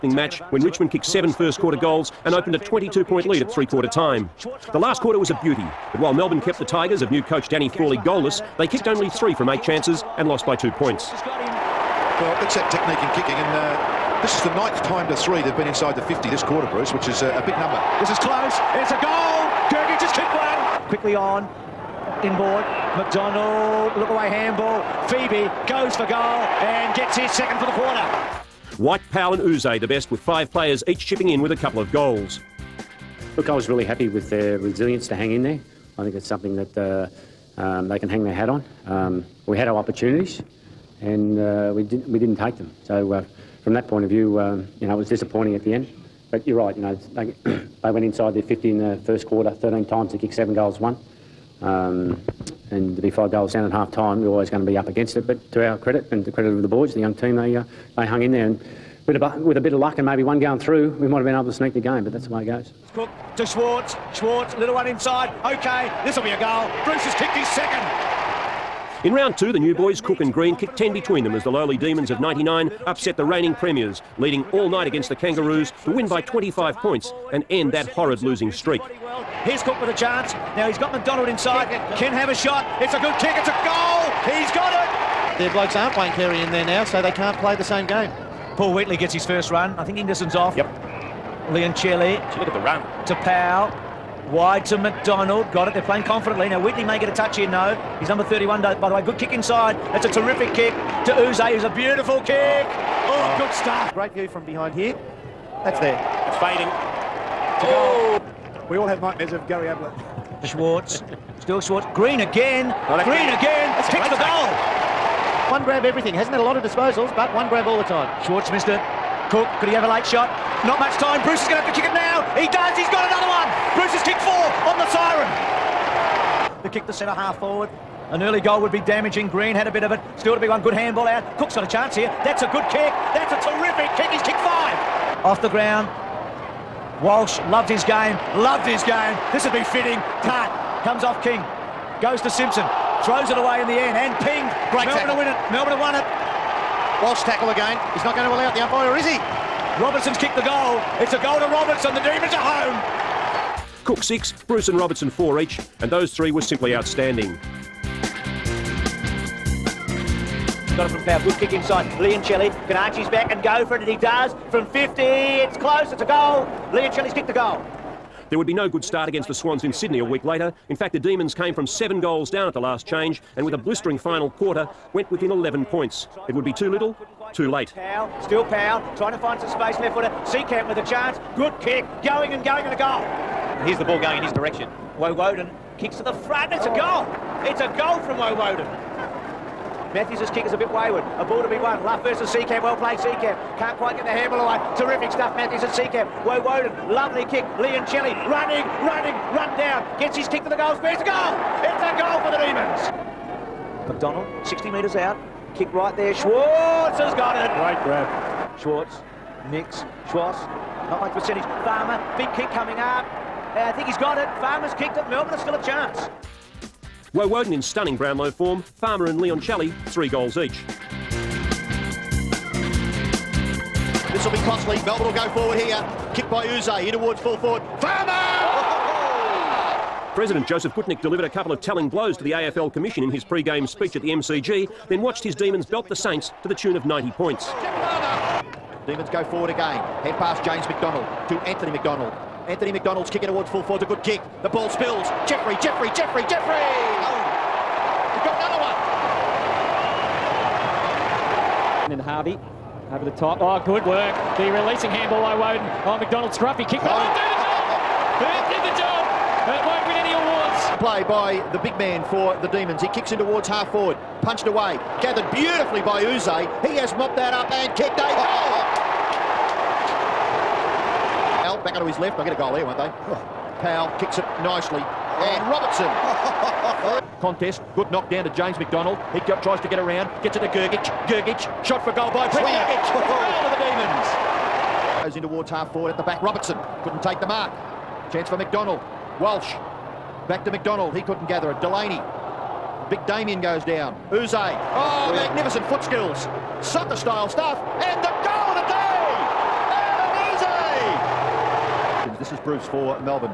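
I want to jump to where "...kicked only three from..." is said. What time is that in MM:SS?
00:08.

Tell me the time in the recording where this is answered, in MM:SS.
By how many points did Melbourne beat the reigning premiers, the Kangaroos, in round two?
01:16.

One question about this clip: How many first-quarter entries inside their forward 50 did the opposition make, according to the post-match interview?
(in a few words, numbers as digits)
13.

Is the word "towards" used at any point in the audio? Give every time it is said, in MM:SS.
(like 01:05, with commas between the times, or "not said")
03:46, 04:03, 04:23, 04:45.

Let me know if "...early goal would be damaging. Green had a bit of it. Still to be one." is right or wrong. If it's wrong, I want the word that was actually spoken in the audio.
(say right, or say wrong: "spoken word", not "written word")
right.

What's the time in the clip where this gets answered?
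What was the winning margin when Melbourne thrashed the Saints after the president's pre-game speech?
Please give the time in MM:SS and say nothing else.
03:56.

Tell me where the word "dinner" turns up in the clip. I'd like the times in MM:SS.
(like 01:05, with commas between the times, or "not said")
not said.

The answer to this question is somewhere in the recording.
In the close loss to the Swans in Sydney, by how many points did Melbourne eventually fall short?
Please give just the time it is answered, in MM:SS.
02:55.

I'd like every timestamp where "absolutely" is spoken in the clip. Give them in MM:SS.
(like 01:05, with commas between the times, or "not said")
not said.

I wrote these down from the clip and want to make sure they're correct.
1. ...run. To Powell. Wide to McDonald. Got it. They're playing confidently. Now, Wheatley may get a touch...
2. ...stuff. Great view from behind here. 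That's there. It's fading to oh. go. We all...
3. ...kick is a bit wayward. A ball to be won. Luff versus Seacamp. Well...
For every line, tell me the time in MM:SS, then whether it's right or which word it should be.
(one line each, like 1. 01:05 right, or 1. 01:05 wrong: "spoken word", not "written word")
1. 01:32 right
2. 01:43 right
3. 03:10 right.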